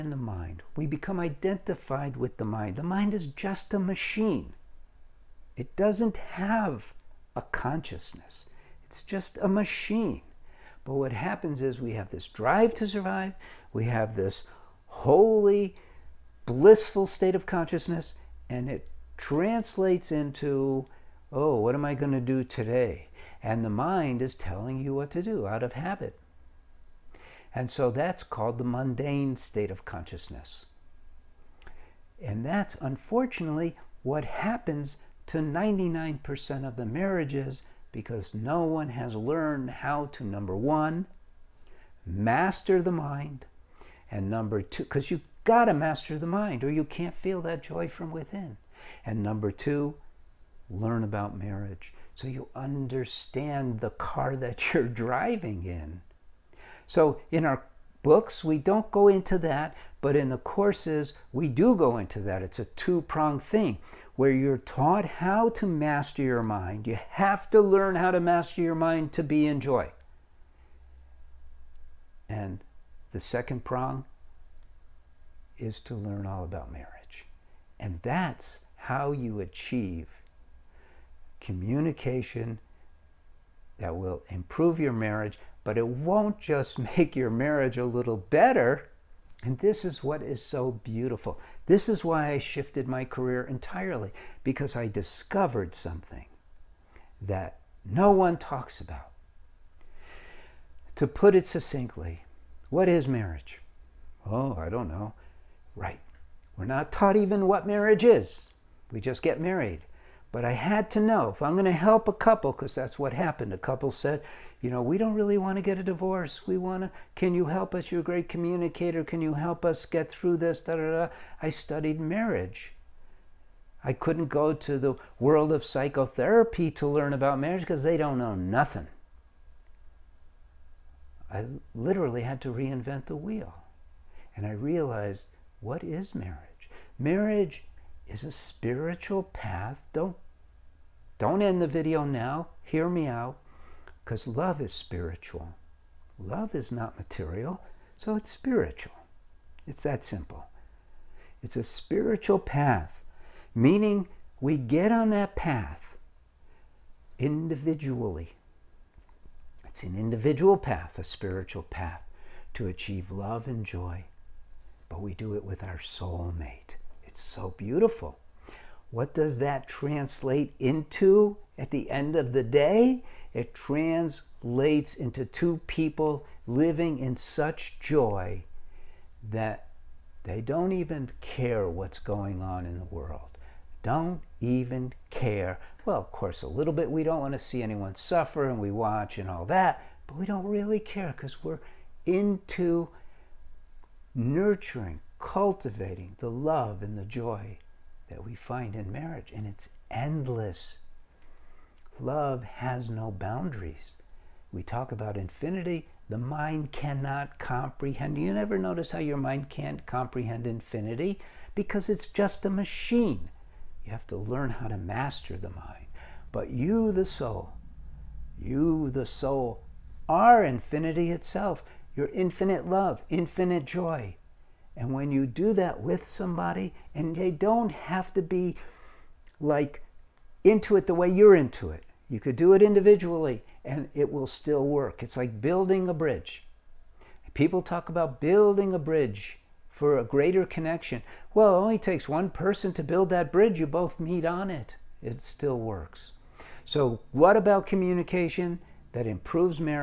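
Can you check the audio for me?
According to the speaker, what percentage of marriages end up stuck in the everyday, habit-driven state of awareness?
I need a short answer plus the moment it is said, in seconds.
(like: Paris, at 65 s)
99%, at 35 s.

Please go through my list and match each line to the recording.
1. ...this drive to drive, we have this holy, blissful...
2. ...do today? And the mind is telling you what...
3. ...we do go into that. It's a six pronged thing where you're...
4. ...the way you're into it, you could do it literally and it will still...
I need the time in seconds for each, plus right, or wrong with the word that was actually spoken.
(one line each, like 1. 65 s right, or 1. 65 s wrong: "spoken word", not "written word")
1. 12 s wrong: "survive", not "drive"
2. 22 s right
3. 61 s wrong: "two", not "six"
4. 230 s wrong: "individually", not "literally".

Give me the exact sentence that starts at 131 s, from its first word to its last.
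I literally had to reinvent the wheel.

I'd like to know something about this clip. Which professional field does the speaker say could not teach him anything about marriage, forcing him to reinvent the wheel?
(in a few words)
psychotherapy.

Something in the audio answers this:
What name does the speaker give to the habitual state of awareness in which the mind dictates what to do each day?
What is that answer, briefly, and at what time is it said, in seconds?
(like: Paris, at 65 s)
mundane state of consciousness, at 28 s.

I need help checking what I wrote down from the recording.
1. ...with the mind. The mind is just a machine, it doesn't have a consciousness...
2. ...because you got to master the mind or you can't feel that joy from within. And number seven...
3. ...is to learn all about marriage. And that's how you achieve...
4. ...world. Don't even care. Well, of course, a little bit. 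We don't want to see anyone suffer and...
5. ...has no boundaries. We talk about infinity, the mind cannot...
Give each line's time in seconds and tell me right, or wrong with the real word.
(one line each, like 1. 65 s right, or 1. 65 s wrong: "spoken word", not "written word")
1. 2 s right
2. 44 s wrong: "two", not "seven"
3. 75 s right
4. 182 s right
5. 202 s right.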